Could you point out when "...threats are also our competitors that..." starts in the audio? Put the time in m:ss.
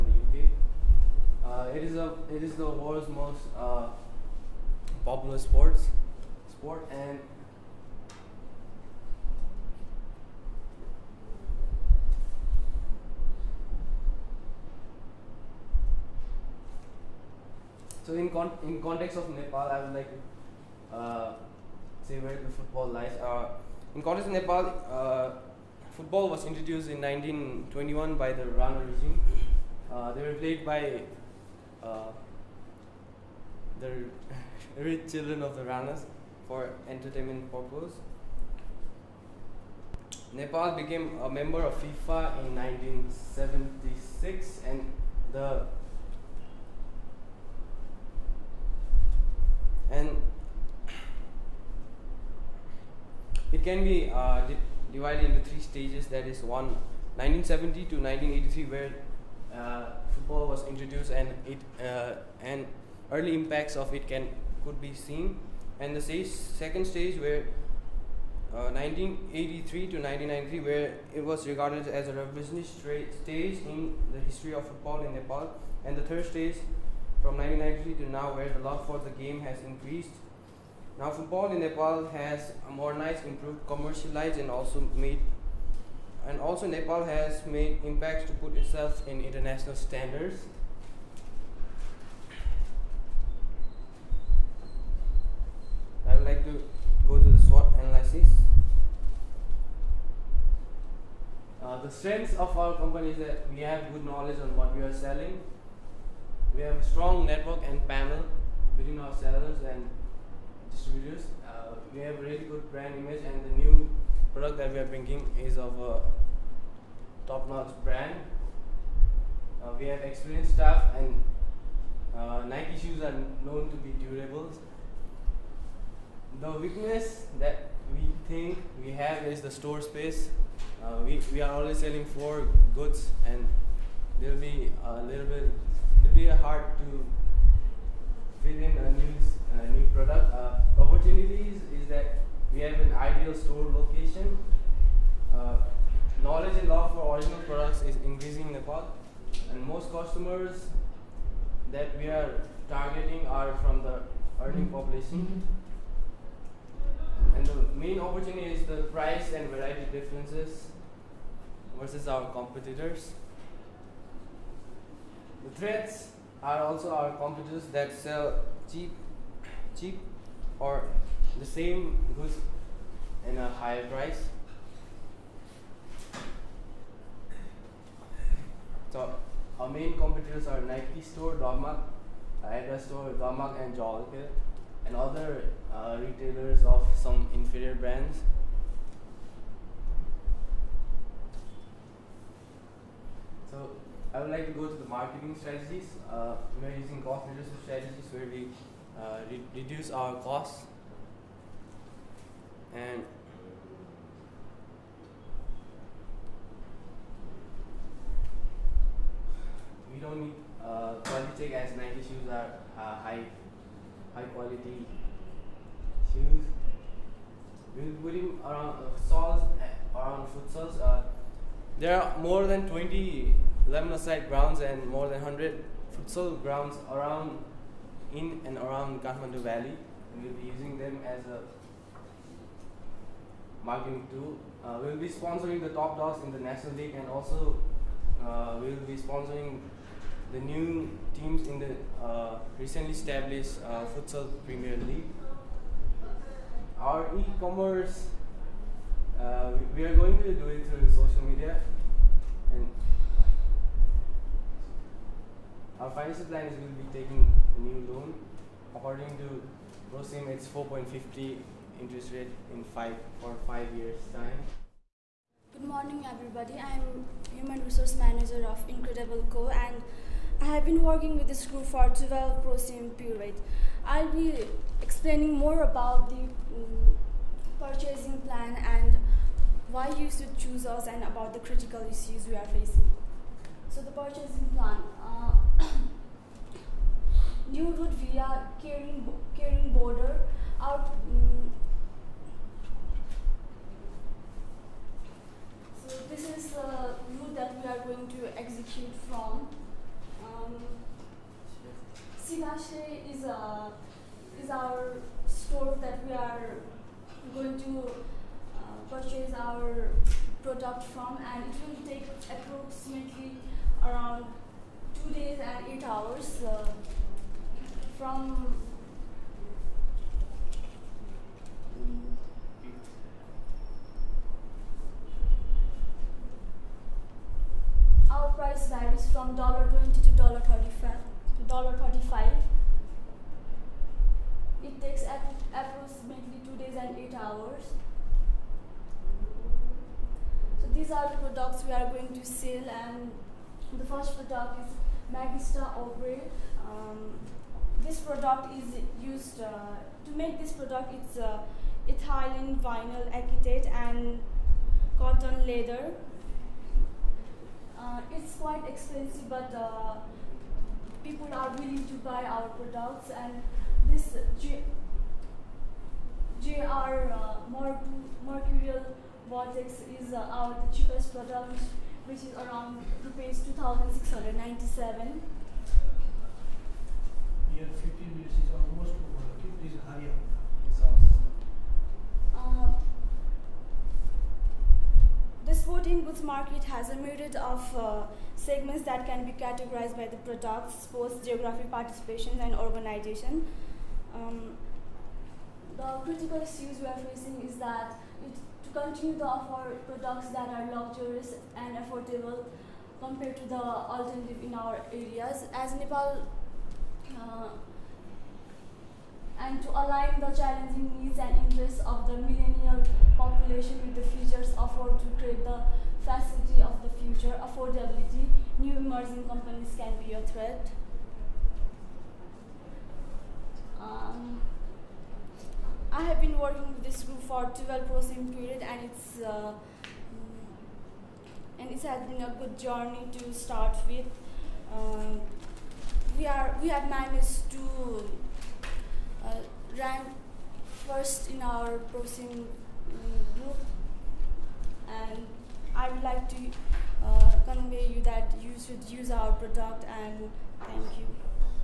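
2:45.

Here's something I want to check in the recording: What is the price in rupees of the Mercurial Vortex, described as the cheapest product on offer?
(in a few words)
2,697 rupees.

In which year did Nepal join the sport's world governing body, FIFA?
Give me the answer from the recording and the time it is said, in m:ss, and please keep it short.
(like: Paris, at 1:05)
1976, at 0:42.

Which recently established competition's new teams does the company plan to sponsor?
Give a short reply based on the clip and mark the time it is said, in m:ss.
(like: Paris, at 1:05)
Futsal Premier League, at 4:03.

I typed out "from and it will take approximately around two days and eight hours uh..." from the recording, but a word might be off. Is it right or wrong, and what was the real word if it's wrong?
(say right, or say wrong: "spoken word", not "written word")
right.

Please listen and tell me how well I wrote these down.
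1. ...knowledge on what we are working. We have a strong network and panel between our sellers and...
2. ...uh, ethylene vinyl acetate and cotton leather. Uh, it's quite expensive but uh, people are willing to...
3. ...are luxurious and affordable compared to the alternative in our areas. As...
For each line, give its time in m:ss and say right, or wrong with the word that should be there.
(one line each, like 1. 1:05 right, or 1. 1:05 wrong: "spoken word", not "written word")
1. 1:44 wrong: "selling", not "working"
2. 5:51 right
3. 6:40 right.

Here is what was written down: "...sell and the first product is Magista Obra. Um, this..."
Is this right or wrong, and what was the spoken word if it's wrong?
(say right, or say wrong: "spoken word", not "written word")
right.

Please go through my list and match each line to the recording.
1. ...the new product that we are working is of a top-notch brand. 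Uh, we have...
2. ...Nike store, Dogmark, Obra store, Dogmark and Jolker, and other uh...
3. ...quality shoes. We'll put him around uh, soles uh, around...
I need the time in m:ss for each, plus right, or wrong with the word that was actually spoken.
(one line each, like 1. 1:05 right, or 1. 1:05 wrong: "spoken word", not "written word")
1. 1:53 wrong: "bringing", not "working"
2. 3:00 wrong: "Adidas", not "Obra"
3. 3:34 right.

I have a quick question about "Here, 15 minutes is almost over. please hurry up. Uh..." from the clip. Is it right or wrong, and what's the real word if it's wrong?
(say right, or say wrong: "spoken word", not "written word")
right.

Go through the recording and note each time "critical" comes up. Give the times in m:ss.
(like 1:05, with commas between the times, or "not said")
4:41, 6:36.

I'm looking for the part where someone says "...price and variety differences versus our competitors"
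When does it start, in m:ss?
2:38.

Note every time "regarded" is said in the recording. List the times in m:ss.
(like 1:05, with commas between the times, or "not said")
1:11.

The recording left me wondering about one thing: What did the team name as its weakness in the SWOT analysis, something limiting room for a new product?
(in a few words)
Store space.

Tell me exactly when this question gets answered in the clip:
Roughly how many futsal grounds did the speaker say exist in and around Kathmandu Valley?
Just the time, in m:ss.
3:44.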